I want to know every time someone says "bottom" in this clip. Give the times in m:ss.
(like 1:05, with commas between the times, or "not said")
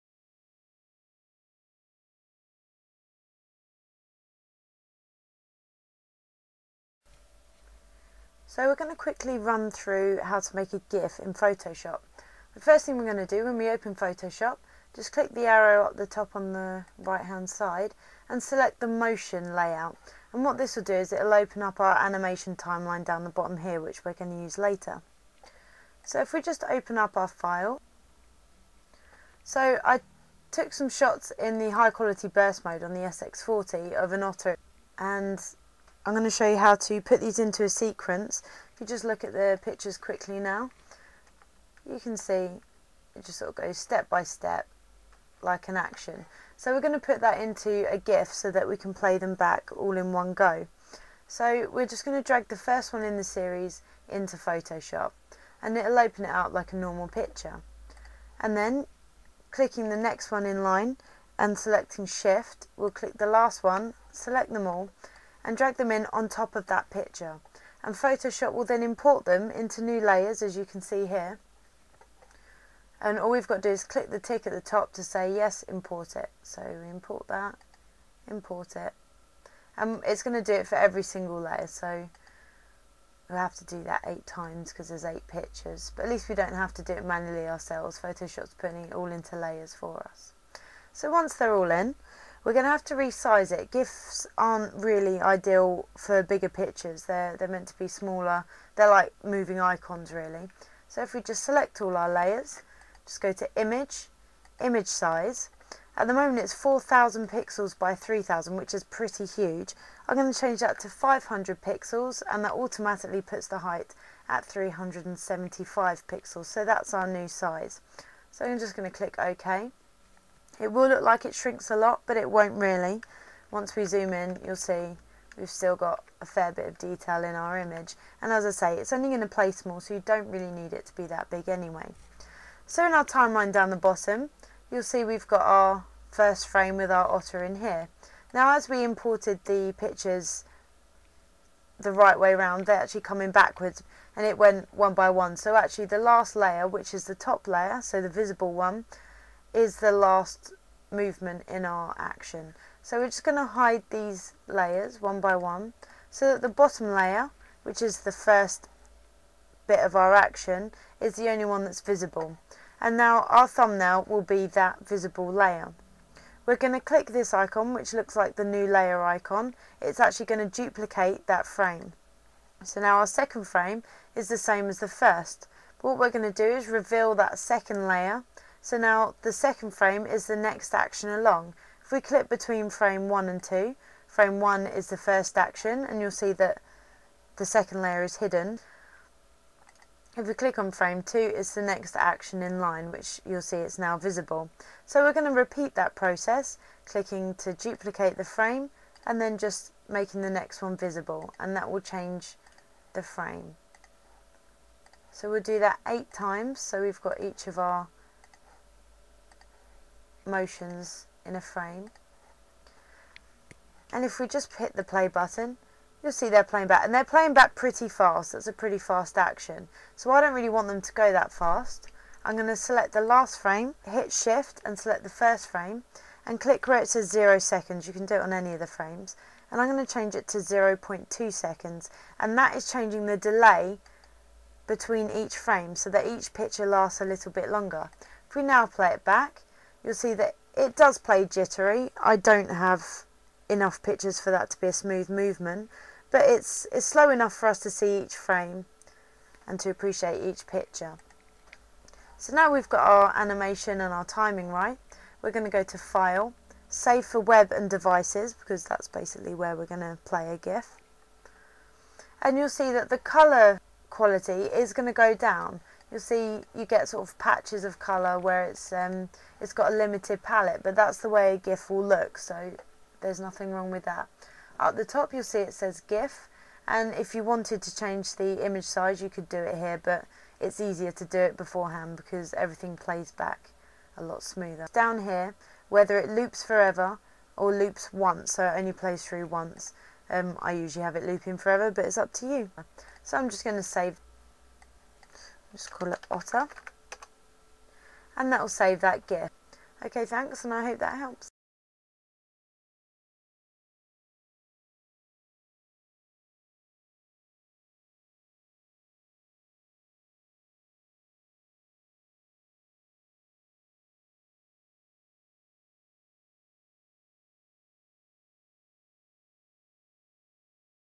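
0:23, 2:13, 2:36.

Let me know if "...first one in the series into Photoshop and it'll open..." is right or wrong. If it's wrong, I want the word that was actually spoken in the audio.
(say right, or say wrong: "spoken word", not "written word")
right.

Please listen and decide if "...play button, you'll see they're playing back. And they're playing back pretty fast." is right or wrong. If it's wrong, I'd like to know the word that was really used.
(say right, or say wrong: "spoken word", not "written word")
right.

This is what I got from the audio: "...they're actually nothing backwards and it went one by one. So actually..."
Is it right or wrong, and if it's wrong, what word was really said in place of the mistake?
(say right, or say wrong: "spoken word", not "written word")
wrong: "coming", not "nothing".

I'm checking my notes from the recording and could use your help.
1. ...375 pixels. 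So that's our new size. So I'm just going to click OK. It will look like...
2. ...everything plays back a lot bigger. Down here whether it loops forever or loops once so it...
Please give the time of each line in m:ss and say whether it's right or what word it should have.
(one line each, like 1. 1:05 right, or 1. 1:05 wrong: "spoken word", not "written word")
1. 1:54 right
2. 4:42 wrong: "smoother", not "bigger".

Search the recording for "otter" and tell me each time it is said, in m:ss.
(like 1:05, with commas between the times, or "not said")
0:34, 2:17, 4:56.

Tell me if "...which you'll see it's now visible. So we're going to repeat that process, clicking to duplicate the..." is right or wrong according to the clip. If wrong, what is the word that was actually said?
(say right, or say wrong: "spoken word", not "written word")
right.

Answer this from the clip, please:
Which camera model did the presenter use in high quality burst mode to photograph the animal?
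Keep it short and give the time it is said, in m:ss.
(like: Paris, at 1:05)
SX40, at 0:32.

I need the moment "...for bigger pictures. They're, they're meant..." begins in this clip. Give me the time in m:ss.
1:35.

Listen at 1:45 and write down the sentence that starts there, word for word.
At the moment it's 4,000 pixels by 3,000, which is pretty huge.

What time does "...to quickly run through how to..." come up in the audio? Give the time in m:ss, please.
0:08.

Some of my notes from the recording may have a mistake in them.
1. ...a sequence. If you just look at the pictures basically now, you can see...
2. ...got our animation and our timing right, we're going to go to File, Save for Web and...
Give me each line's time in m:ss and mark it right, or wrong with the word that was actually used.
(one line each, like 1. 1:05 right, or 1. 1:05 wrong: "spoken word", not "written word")
1. 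0:37 wrong: "quickly", not "basically"
2. 4:12 right.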